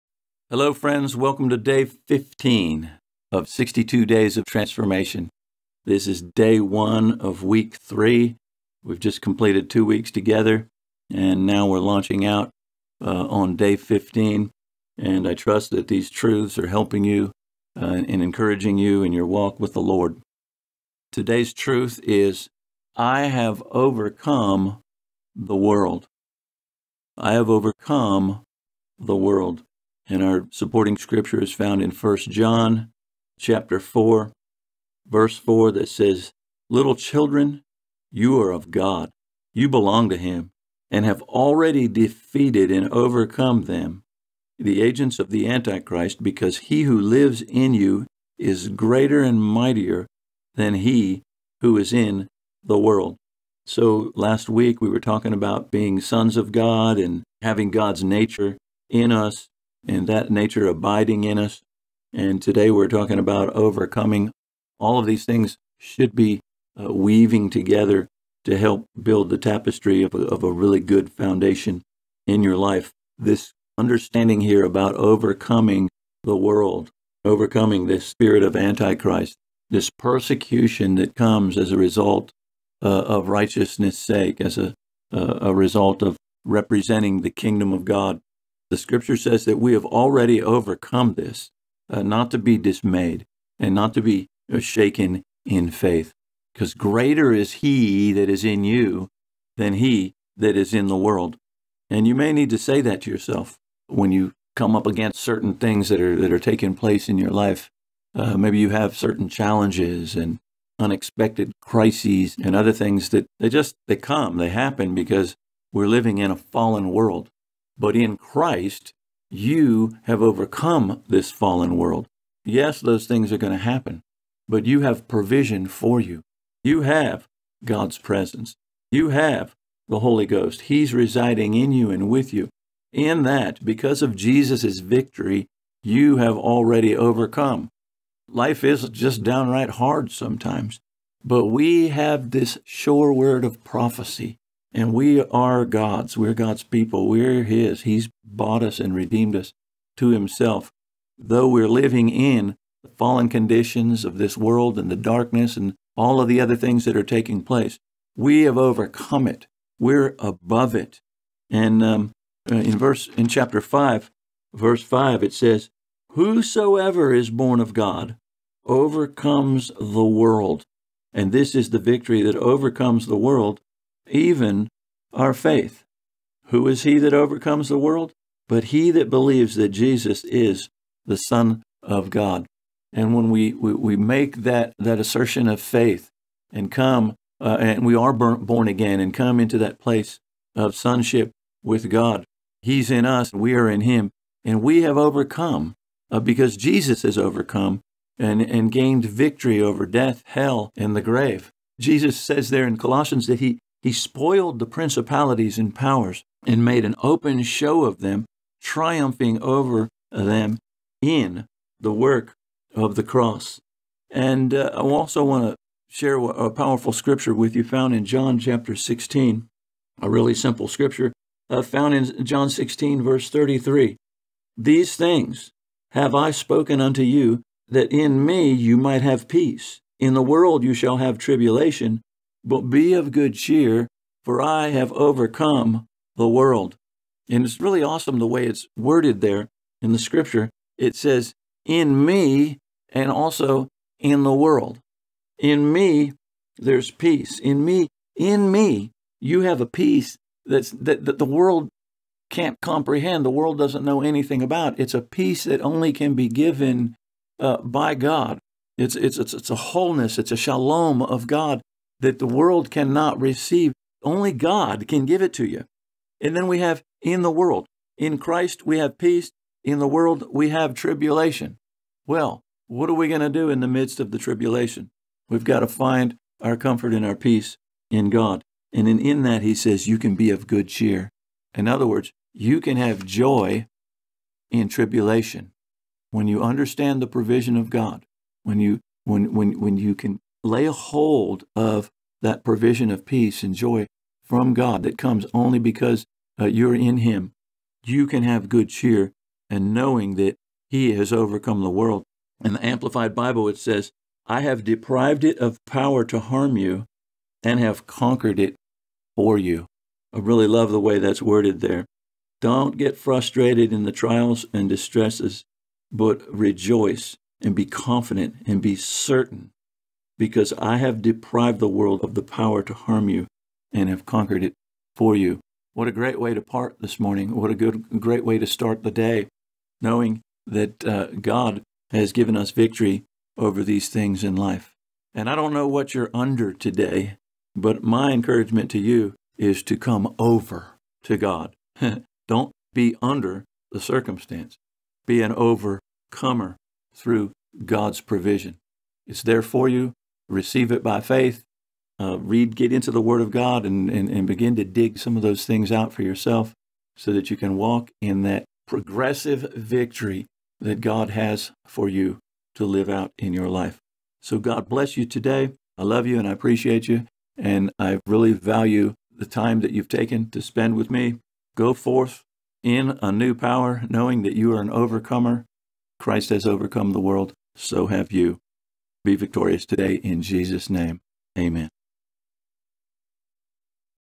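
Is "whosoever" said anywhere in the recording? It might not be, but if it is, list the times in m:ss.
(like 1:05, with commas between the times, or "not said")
2:46.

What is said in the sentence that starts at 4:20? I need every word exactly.
It's a shalom of God that the world cannot receive.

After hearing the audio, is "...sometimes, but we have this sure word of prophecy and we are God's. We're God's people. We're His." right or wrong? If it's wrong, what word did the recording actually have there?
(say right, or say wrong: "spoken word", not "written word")
right.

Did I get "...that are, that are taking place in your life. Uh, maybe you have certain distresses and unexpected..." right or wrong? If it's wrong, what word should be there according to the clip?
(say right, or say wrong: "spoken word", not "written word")
wrong: "challenges", not "distresses".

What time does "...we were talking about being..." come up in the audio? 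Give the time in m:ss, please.
0:54.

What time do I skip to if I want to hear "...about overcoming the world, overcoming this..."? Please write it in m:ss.
1:14.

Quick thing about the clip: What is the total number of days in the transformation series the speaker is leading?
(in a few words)
62.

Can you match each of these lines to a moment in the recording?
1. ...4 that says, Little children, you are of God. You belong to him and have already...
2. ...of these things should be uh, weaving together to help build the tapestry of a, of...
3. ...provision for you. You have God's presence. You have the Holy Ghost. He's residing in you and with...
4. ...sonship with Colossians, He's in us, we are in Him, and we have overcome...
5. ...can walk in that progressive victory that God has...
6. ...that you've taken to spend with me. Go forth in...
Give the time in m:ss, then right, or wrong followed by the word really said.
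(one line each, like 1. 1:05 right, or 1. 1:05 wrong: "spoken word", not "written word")
1. 0:35 right
2. 1:04 right
3. 2:05 right
4. 3:10 wrong: "God", not "Colossians"
5. 5:57 right
6. 6:09 right.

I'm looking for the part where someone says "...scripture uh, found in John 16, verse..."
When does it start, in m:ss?
3:40.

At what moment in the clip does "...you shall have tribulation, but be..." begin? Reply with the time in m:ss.
3:50.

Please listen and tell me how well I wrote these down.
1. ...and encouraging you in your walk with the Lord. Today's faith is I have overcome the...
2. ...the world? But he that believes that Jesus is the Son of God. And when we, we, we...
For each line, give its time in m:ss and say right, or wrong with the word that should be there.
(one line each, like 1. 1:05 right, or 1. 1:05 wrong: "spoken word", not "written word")
1. 0:18 wrong: "truth", not "faith"
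2. 2:57 right.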